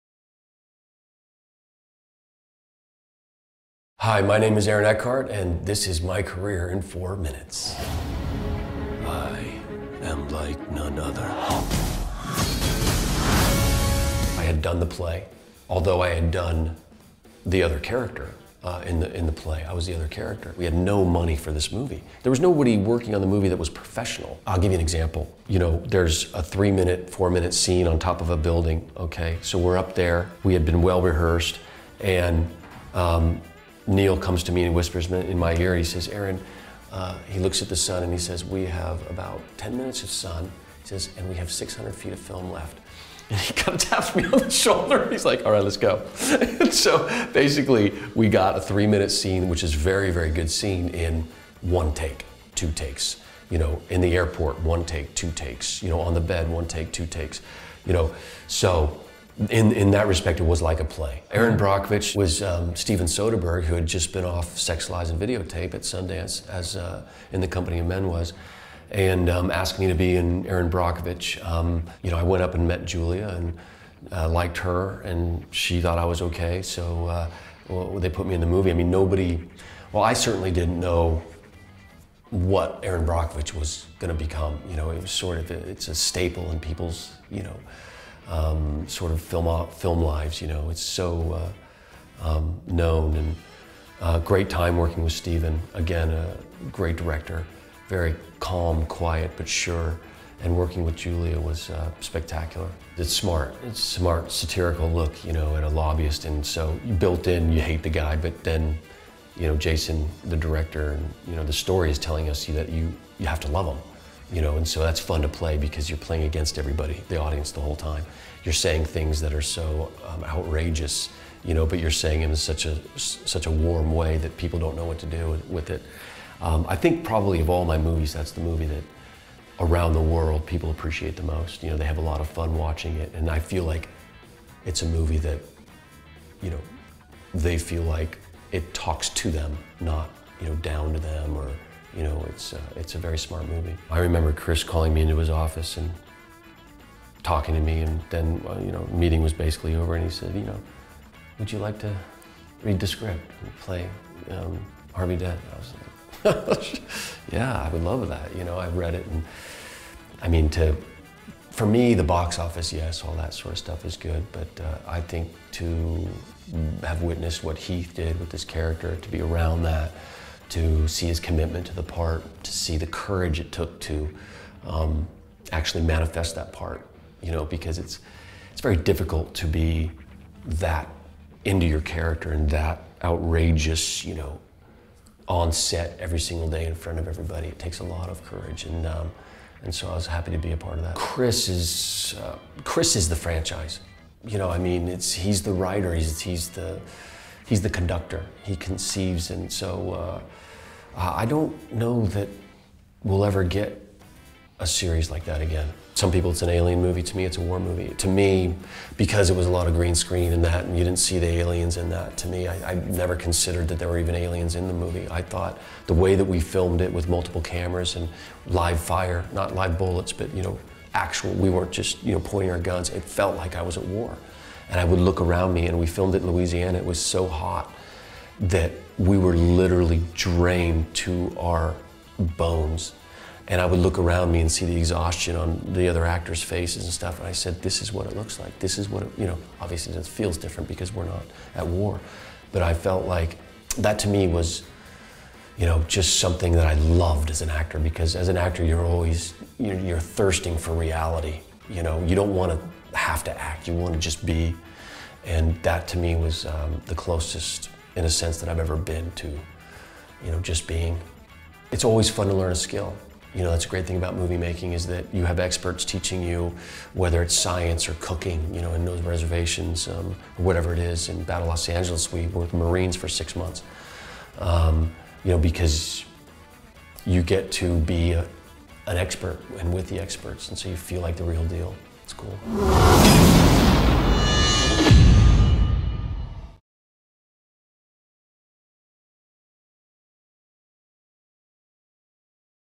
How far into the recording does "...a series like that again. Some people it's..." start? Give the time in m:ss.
3:24.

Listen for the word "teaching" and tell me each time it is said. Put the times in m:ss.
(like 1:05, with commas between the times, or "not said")
4:25.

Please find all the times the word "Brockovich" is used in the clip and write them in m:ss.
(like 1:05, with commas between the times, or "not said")
1:01, 1:10, 1:23.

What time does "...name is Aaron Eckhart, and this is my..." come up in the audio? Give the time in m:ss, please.
0:04.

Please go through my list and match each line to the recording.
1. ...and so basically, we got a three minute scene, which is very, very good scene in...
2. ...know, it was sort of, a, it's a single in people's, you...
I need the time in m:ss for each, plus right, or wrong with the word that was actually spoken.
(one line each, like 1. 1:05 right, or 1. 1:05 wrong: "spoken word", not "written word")
1. 0:46 right
2. 1:24 wrong: "staple", not "single".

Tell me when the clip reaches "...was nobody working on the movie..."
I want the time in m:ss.
0:22.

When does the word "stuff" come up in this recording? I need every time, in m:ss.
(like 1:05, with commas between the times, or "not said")
2:43, 3:56.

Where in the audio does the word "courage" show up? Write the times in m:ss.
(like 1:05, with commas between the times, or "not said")
2:52, 3:08.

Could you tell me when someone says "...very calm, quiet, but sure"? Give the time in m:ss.
1:37.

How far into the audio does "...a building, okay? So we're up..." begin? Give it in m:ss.
0:28.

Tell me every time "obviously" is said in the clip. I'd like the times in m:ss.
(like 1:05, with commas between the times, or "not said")
3:59.